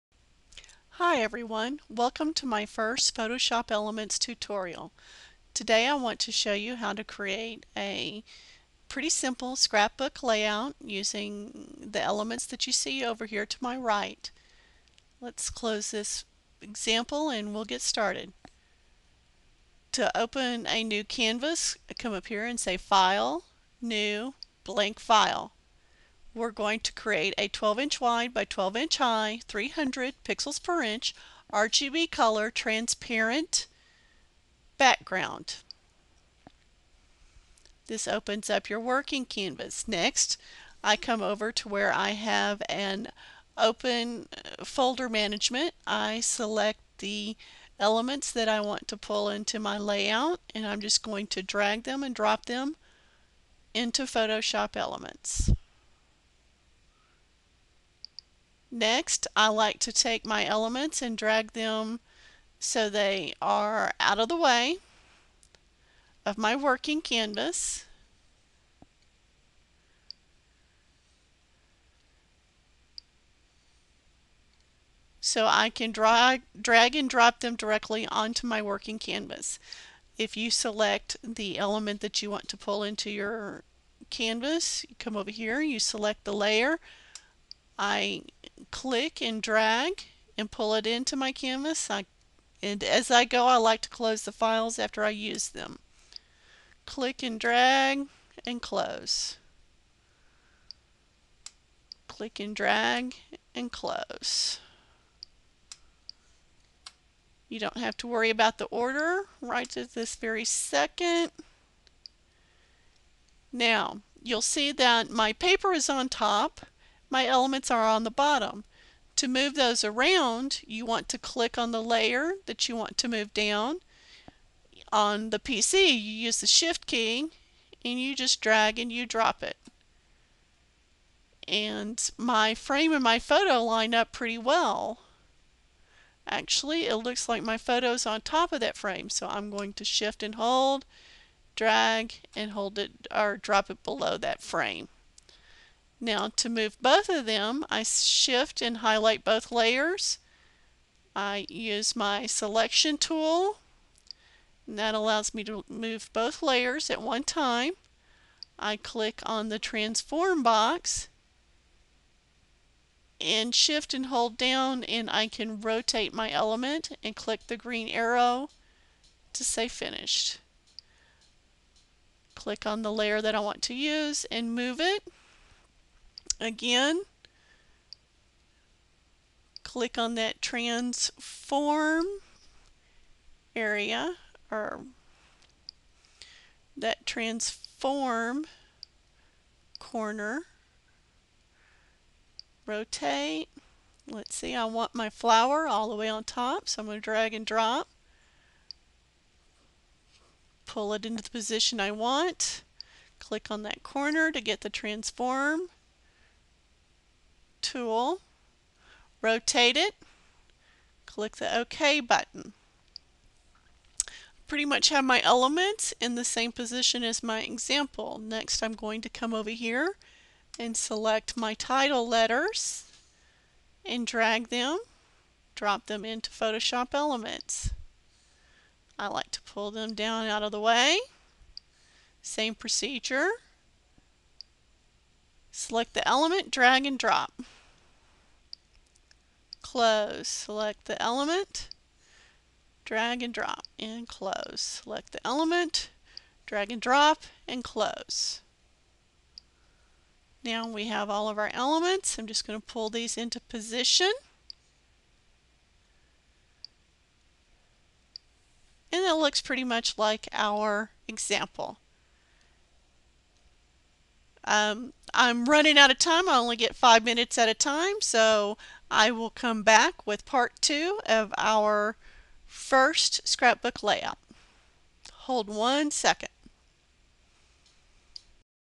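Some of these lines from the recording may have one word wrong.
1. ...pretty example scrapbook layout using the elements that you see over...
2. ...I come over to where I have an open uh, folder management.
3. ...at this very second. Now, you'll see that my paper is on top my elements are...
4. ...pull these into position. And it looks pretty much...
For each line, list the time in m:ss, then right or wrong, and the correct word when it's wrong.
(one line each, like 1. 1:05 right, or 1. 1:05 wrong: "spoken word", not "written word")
1. 0:08 wrong: "simple", not "example"
2. 0:40 right
3. 1:49 right
4. 4:12 right.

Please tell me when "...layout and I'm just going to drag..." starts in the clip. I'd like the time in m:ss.
0:49.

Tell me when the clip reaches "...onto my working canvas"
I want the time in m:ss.
1:18.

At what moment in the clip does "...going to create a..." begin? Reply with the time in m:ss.
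0:26.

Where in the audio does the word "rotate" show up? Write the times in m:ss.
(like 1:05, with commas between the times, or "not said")
2:45, 3:12, 3:29.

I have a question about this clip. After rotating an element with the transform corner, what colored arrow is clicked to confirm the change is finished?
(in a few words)
Green arrow.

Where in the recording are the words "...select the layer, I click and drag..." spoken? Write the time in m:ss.
1:25.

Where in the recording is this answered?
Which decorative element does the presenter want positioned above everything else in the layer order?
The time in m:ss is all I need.
3:15.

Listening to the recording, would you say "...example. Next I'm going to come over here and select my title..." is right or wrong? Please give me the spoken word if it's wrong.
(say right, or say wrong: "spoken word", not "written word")
right.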